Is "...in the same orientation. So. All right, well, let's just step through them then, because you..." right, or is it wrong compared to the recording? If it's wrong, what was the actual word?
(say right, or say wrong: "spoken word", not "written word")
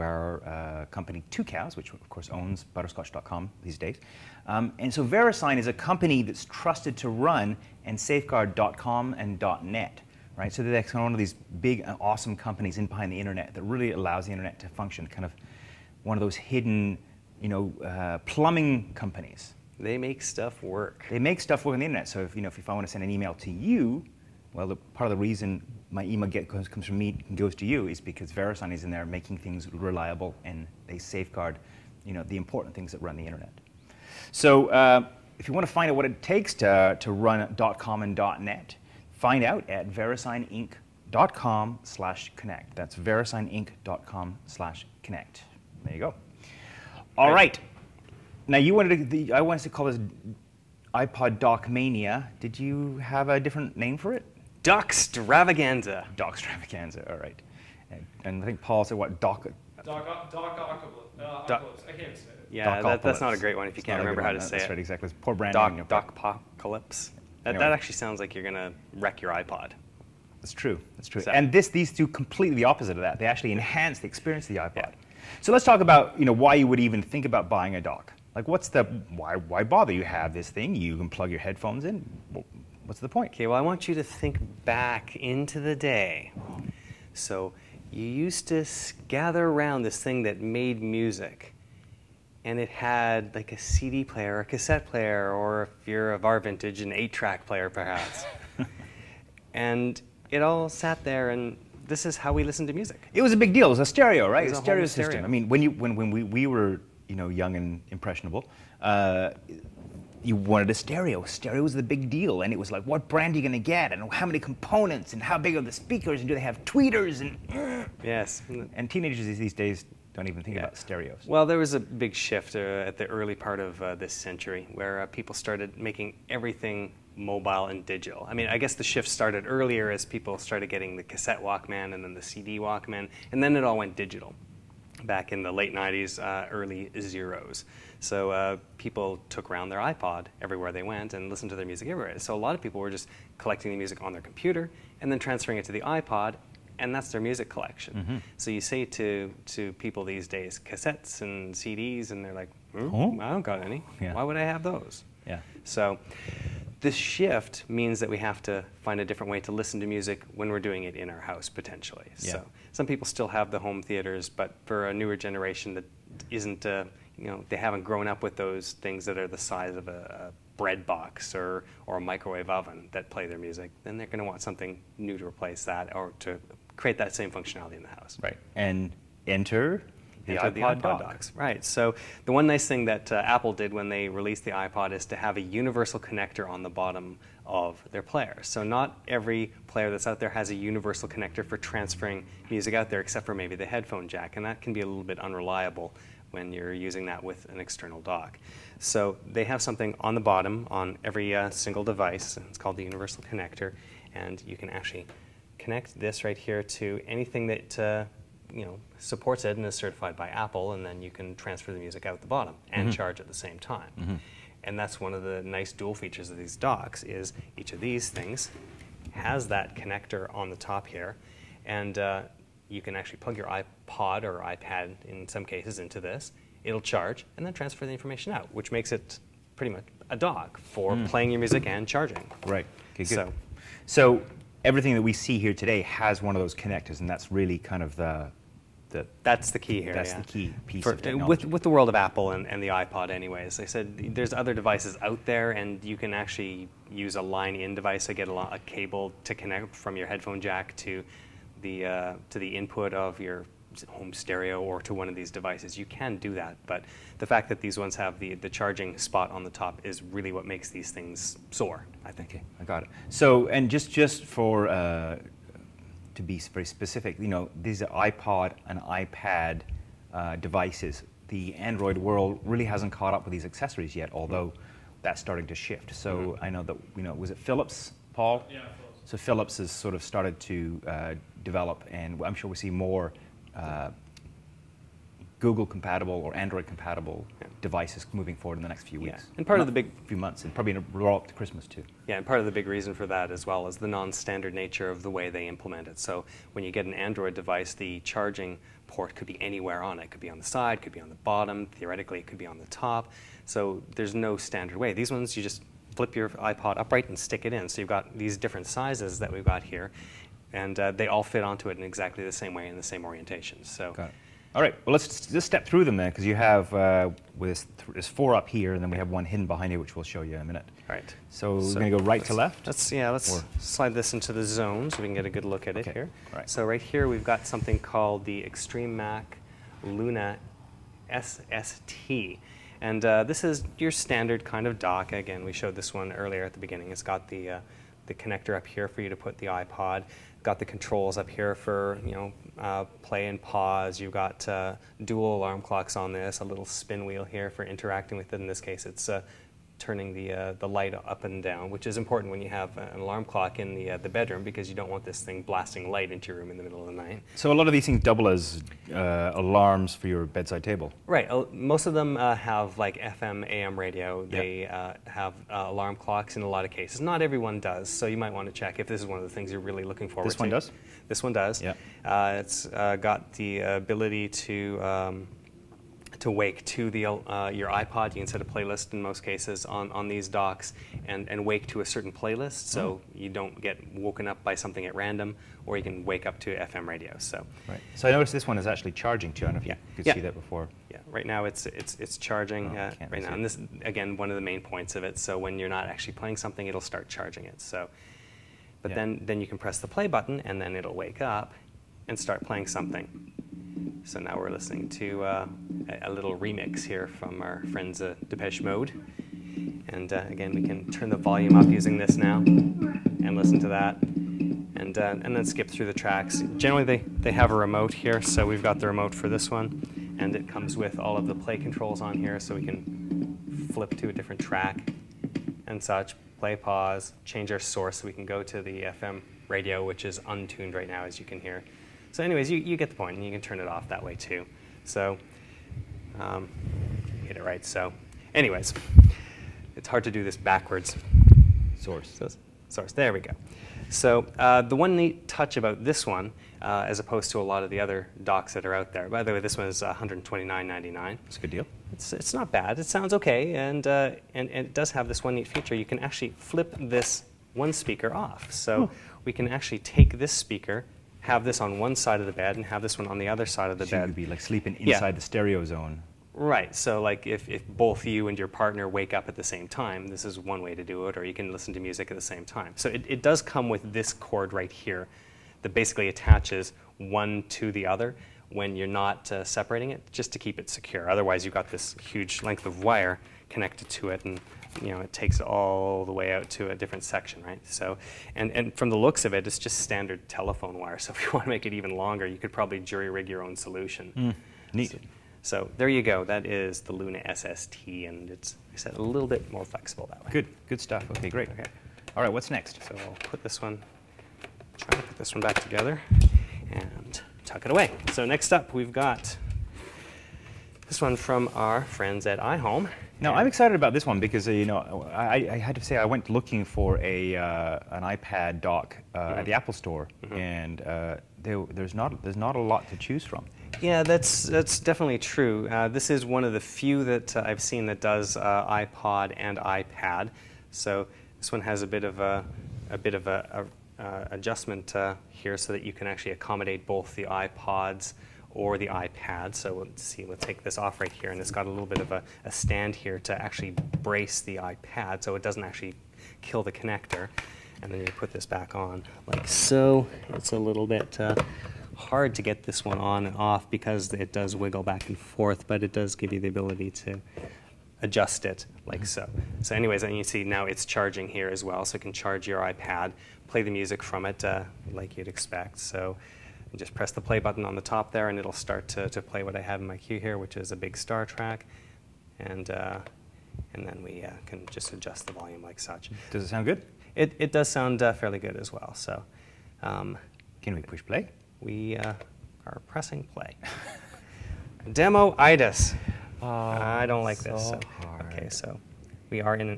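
right.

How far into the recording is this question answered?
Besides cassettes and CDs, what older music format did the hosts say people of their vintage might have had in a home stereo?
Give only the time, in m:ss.
1:36.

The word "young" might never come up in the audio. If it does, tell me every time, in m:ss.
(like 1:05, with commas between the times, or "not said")
1:47.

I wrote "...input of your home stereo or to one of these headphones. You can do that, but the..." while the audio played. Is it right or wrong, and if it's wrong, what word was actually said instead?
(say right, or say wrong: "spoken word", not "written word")
wrong: "devices", not "headphones".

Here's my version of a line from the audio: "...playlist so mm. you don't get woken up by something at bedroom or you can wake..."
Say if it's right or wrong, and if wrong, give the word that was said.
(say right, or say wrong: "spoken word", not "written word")
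wrong: "random", not "bedroom".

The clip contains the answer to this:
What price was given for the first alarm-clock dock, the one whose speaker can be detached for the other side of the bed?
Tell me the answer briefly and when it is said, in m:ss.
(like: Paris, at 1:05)
$129.99, at 7:29.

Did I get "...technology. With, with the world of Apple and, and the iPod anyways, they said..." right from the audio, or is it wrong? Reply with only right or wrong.
right.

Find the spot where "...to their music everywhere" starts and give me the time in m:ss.
2:21.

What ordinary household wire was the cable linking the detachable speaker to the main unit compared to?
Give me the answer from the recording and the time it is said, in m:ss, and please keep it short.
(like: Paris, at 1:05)
telephone wire, at 8:10.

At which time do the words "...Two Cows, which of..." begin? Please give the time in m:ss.
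0:01.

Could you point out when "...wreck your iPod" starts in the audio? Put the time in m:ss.
1:08.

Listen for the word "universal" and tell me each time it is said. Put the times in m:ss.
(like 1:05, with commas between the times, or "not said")
3:05, 3:10, 3:22.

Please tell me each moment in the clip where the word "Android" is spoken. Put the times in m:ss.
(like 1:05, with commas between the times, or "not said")
4:31, 4:46, 4:56.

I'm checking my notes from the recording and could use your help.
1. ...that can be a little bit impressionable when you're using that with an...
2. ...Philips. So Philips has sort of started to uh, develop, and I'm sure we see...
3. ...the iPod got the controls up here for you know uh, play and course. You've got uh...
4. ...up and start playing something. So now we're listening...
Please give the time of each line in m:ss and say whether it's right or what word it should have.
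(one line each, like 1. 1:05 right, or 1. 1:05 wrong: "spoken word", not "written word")
1. 3:14 wrong: "unreliable", not "impressionable"
2. 4:38 right
3. 5:39 wrong: "pause", not "course"
4. 6:41 right.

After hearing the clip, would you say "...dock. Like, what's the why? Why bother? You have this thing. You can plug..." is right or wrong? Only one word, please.
right.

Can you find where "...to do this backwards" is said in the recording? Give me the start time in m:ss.
7:20.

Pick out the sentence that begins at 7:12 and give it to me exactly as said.
So anyways, you, you get the point, and you can turn it off that way too.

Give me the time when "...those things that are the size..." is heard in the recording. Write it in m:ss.
2:48.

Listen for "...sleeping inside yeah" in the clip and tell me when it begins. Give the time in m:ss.
7:44.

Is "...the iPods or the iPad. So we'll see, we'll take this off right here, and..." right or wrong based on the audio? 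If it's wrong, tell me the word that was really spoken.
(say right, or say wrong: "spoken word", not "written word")
right.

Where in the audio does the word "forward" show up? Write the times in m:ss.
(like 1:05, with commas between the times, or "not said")
4:48, 6:10.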